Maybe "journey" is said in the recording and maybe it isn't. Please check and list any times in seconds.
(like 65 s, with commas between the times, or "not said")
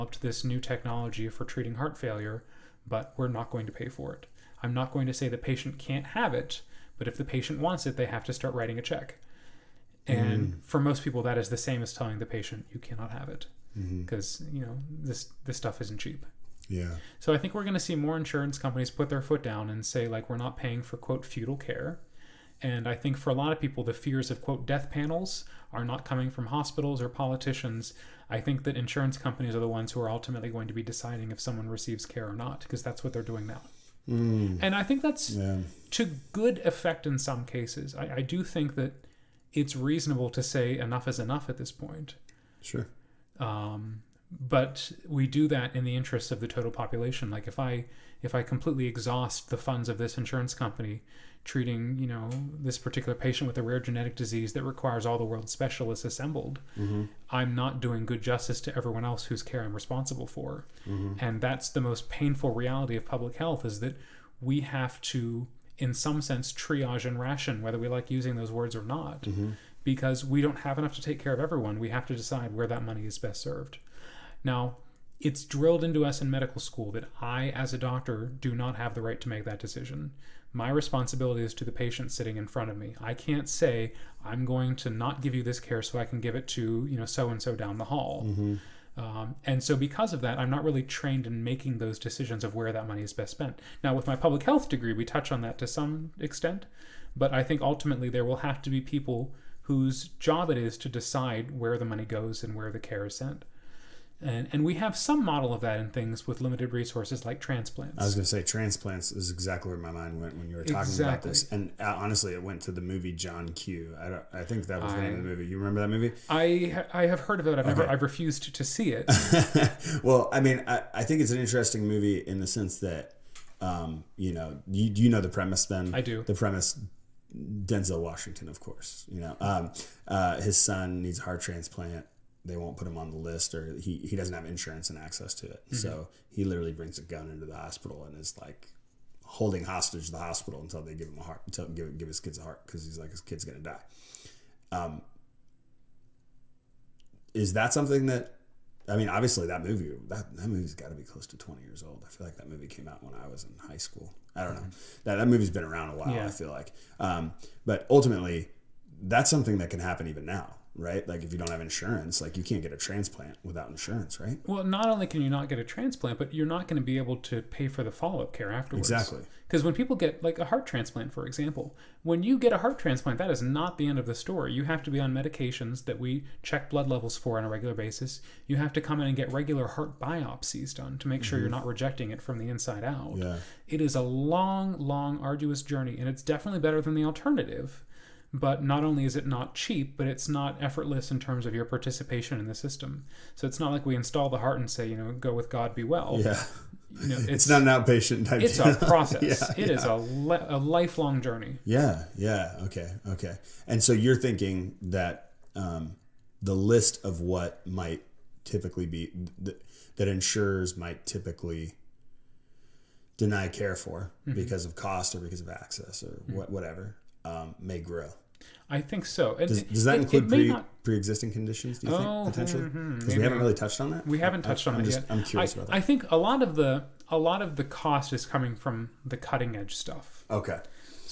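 185 s, 201 s.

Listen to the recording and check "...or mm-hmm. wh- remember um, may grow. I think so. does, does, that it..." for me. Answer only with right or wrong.
wrong.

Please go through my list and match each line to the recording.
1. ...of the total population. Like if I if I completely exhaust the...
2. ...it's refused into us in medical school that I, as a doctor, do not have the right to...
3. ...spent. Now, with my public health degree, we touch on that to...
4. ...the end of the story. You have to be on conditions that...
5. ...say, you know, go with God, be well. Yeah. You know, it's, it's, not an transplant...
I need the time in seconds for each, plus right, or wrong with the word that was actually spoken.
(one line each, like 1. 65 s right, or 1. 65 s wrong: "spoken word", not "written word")
1. 46 s right
2. 75 s wrong: "drilled", not "refused"
3. 93 s right
4. 173 s wrong: "medications", not "conditions"
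5. 194 s wrong: "outpatient", not "transplant".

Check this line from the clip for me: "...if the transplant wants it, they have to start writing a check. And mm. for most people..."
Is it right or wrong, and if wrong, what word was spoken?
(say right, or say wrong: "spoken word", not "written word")
wrong: "patient", not "transplant".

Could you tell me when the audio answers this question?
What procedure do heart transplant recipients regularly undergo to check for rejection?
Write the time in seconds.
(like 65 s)
179 s.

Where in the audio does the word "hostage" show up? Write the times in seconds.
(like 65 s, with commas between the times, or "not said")
139 s.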